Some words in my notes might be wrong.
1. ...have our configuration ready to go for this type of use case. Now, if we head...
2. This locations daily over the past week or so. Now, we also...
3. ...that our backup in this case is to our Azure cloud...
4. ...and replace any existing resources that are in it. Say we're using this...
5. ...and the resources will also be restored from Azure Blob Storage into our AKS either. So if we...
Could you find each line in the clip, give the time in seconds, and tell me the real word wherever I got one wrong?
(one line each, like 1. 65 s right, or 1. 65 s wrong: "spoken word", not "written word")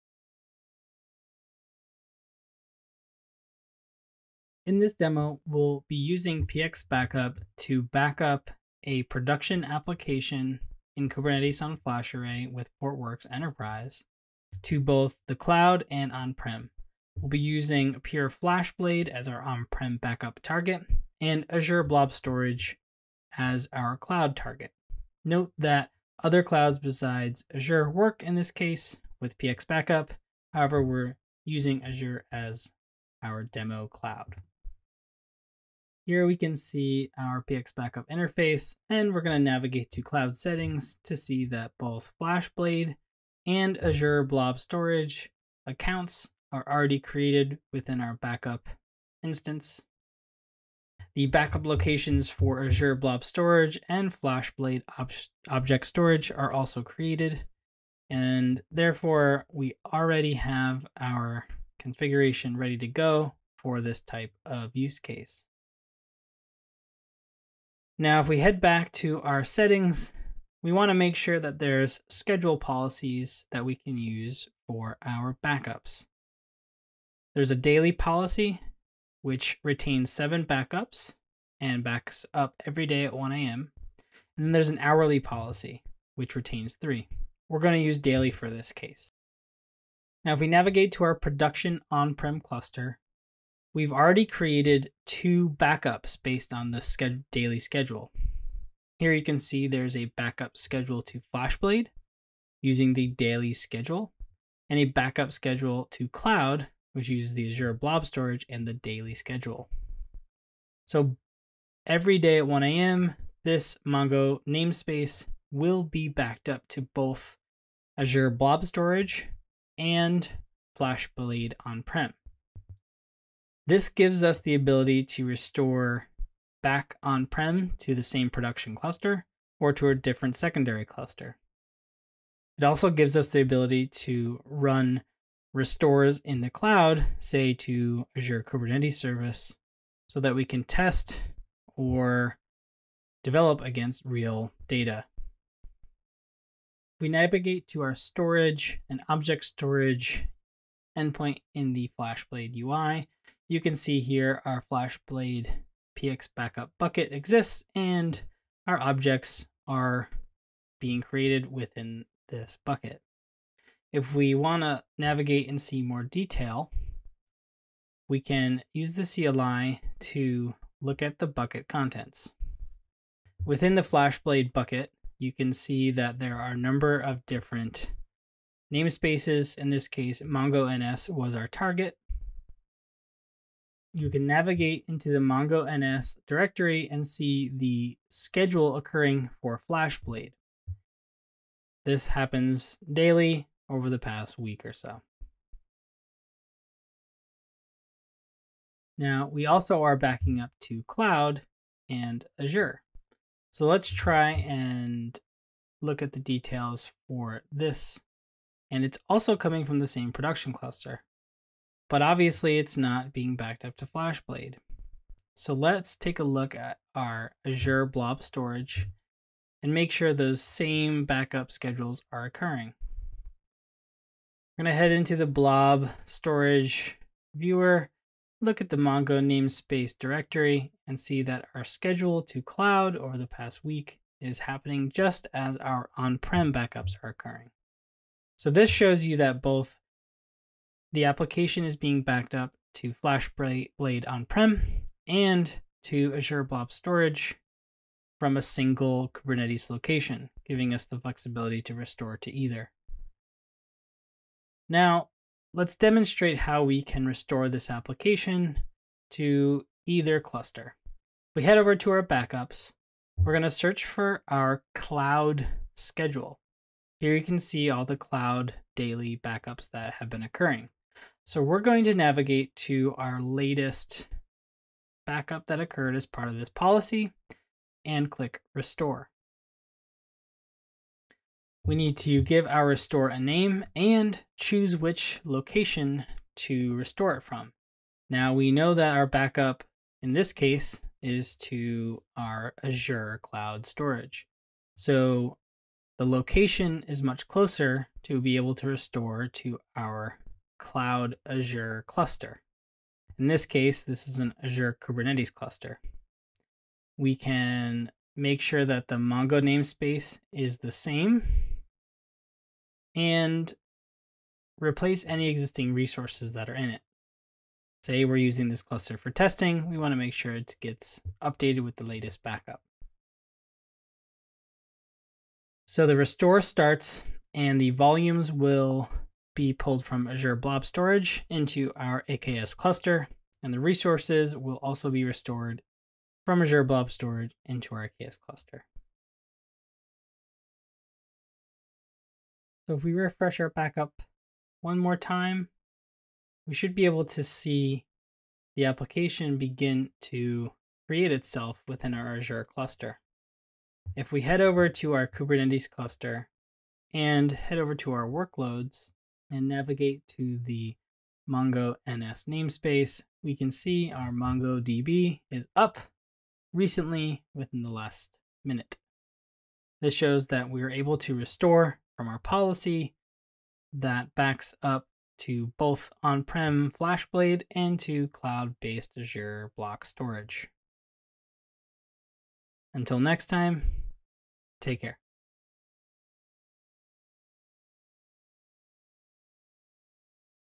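1. 60 s right
2. 191 s wrong: "happens", not "locations"
3. 288 s right
4. 312 s right
5. 333 s wrong: "cluster", not "either".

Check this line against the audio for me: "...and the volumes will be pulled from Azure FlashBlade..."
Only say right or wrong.
wrong.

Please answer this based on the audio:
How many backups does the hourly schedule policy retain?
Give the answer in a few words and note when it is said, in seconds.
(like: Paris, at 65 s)
3, at 86 s.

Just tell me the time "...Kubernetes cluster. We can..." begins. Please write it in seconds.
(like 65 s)
304 s.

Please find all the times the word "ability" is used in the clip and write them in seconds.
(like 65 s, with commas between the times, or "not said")
124 s, 133 s.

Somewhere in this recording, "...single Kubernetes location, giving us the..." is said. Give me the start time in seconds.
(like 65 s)
248 s.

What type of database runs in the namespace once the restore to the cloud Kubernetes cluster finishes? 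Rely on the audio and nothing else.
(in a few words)
MongoDB.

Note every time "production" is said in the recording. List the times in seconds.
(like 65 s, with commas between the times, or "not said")
9 s, 91 s, 128 s, 210 s.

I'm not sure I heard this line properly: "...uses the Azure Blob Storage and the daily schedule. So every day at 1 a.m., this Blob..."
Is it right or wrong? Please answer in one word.
wrong.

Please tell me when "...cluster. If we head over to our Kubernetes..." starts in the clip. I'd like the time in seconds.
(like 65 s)
352 s.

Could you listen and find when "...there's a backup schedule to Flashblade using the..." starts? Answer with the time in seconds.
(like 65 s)
99 s.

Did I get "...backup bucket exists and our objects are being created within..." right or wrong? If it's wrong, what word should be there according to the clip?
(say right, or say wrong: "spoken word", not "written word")
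right.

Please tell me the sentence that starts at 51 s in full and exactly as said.
The backup locations for Azure Blob Storage and FlashBlade ob Object Storage are also created.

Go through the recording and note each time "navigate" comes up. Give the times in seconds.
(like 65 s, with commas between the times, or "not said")
39 s, 90 s, 147 s, 164 s, 184 s, 271 s, 359 s.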